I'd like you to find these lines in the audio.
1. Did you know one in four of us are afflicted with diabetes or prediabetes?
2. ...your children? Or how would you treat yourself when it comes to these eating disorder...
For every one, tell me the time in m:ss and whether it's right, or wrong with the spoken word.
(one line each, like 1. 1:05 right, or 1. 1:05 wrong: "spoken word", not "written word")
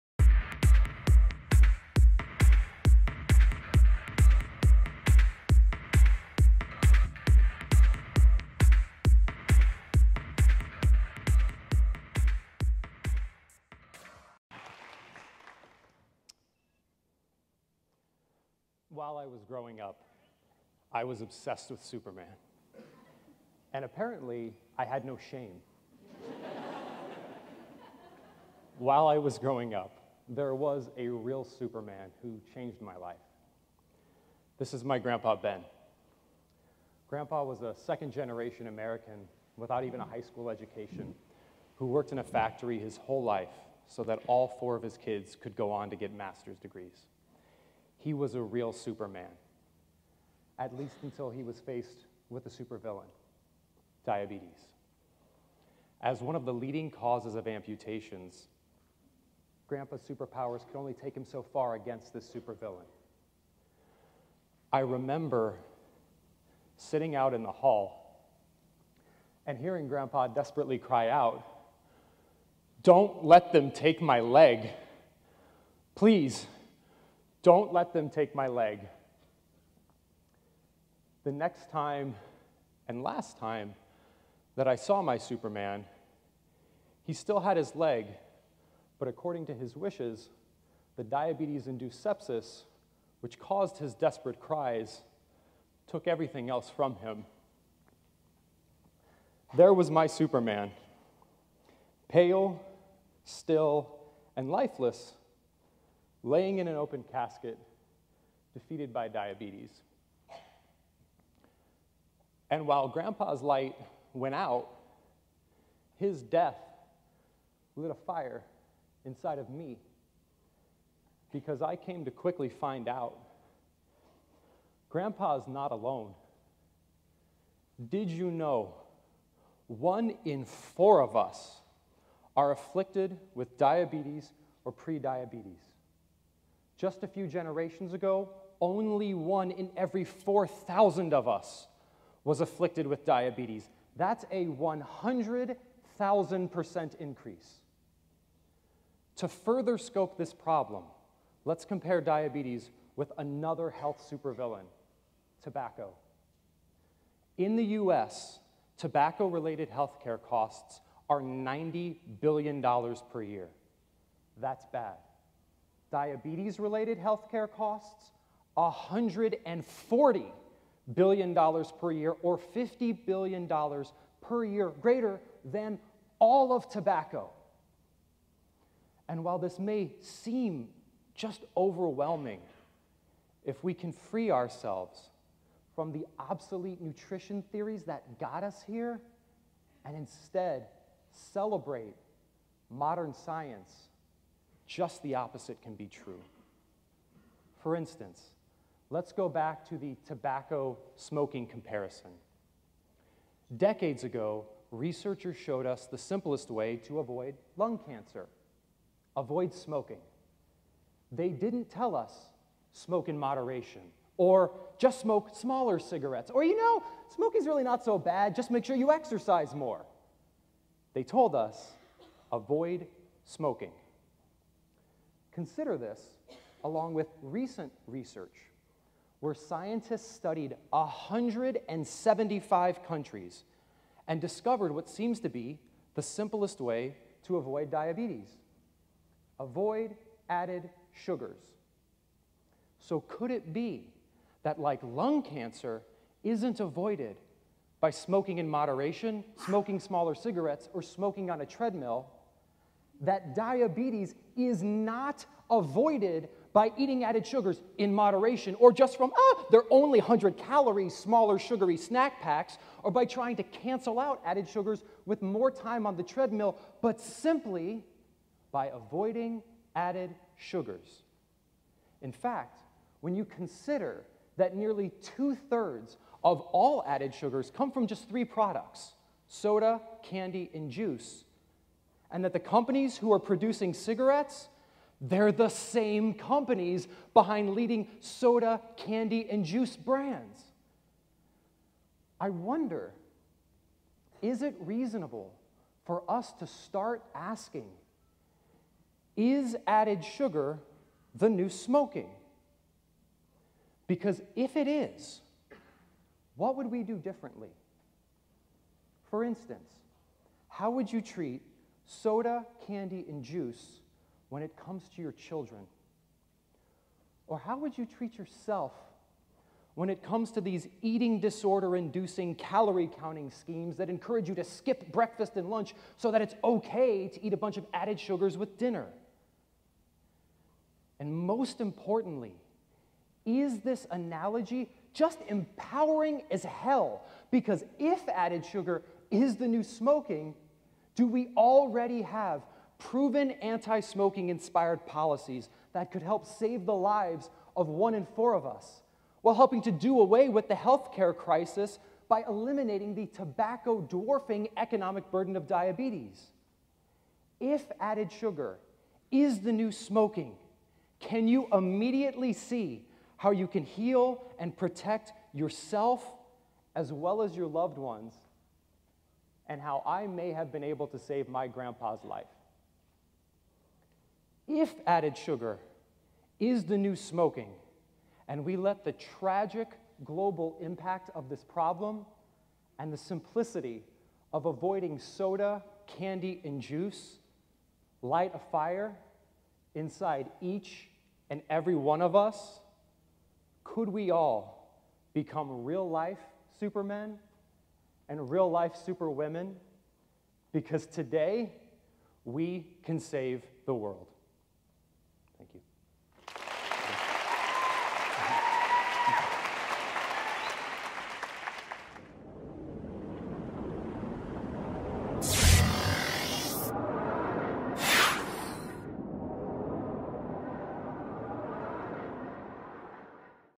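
1. 2:07 right
2. 5:15 right.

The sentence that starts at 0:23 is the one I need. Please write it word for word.
And apparently, I had no shame.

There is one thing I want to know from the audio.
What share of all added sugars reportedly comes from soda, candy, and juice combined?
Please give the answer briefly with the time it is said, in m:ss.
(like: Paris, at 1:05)
Two thirds, at 4:35.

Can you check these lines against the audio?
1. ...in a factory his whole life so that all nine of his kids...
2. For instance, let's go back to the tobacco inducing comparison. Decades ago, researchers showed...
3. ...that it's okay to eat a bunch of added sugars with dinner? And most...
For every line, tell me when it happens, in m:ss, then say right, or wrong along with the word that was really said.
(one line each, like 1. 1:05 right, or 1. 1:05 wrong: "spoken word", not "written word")
1. 0:42 wrong: "four", not "nine"
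2. 3:17 wrong: "smoking", not "inducing"
3. 5:26 right.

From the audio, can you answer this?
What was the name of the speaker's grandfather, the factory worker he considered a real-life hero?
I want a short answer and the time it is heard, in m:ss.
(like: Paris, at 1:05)
Ben, at 0:35.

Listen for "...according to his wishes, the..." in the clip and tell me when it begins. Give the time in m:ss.
1:29.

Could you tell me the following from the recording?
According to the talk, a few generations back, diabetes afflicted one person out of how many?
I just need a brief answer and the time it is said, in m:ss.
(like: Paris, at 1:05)
4,000, at 2:20.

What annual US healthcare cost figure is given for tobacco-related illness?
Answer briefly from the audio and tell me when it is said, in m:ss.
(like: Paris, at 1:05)
$90 billion, at 2:41.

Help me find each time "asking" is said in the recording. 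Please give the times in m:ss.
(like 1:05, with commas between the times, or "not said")
4:57.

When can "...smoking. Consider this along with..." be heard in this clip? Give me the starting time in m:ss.
3:43.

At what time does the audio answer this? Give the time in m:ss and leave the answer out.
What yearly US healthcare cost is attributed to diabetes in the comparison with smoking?
2:48.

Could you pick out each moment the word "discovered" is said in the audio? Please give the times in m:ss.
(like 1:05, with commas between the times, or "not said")
3:54.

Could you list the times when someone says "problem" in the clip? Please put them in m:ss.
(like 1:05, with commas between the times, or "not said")
2:30, 6:21.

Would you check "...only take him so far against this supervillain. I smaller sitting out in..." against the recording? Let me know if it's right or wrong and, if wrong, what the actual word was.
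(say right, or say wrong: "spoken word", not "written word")
wrong: "remember", not "smaller".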